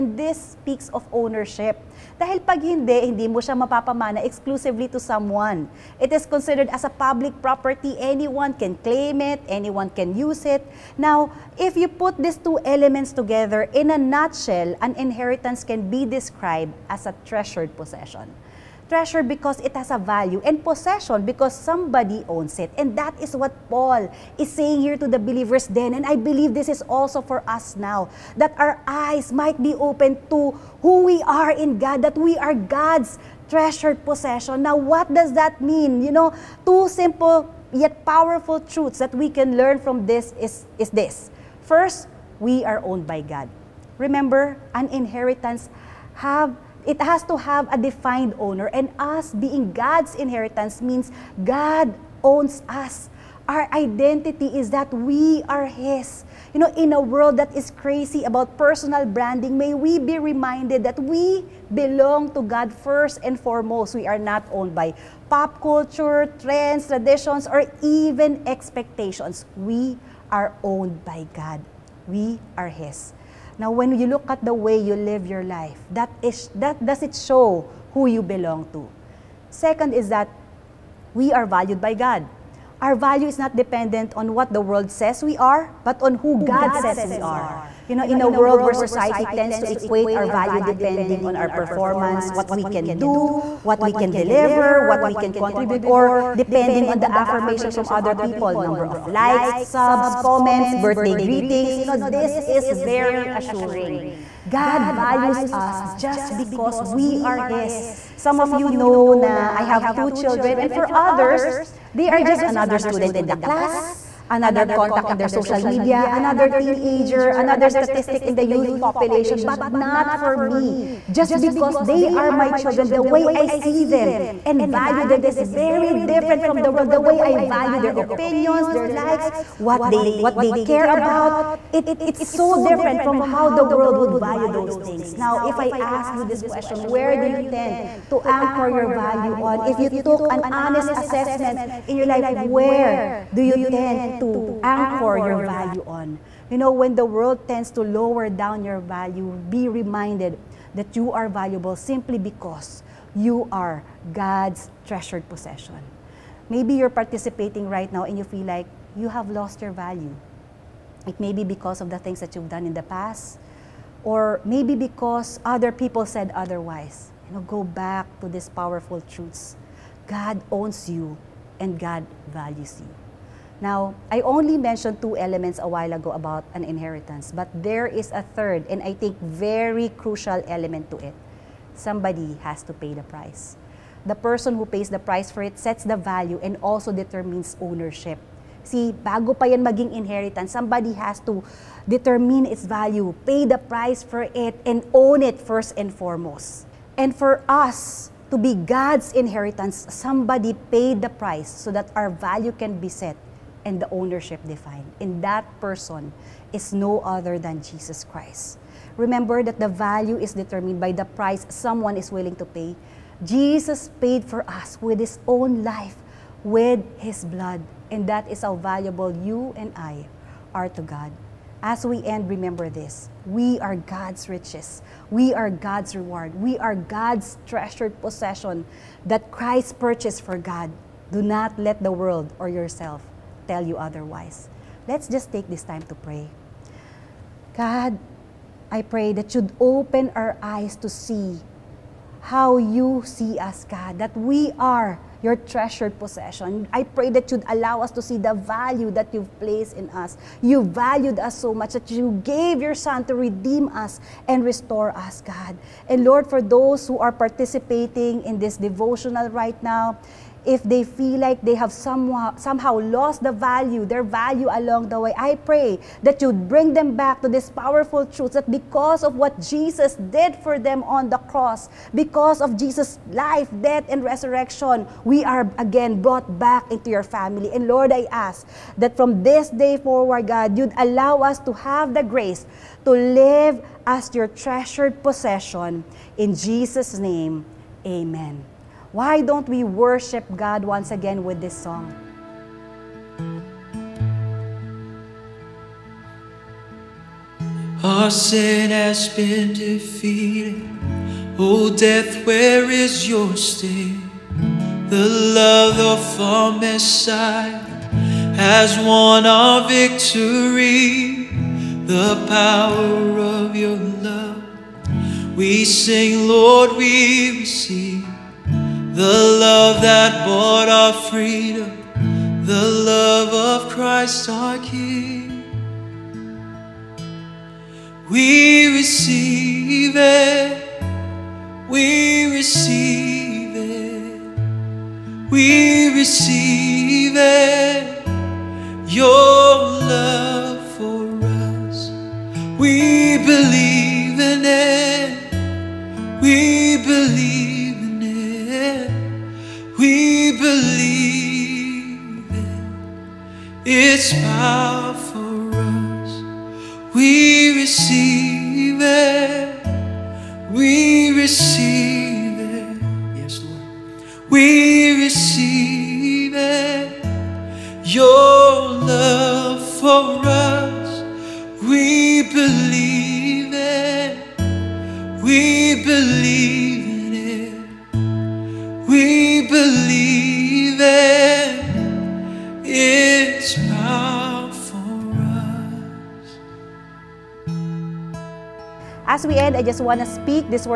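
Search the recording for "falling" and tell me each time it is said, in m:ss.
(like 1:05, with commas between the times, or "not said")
not said.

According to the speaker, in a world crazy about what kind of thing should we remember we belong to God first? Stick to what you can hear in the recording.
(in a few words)
personal branding.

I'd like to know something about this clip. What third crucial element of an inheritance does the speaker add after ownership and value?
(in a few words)
Somebody has to pay the price.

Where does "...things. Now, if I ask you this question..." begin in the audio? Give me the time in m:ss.
2:14.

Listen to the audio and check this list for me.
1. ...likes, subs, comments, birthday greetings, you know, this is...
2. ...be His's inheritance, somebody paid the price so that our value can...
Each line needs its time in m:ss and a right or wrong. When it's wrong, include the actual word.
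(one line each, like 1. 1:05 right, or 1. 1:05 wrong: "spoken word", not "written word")
1. 1:39 right
2. 3:18 wrong: "God", not "His".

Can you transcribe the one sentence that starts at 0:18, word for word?
treasure because it has a value, and possession because somebody owns it.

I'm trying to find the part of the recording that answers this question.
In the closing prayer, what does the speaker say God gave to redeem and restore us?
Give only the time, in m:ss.
4:12.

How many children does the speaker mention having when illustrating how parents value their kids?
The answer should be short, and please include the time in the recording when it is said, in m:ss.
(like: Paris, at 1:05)
2, at 1:49.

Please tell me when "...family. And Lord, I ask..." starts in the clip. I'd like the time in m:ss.
4:37.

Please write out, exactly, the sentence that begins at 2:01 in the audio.
Just because they are my children, the way I see them and value them is very different from the world.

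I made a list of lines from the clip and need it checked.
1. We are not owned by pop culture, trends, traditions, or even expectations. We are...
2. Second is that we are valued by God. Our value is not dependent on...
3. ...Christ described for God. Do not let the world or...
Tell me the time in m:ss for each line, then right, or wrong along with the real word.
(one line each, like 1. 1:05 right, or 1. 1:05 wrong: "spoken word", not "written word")
1. 1:03 right
2. 1:19 right
3. 3:49 wrong: "purchased", not "described".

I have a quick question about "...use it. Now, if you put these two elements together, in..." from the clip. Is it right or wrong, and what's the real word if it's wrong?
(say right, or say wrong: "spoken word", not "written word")
right.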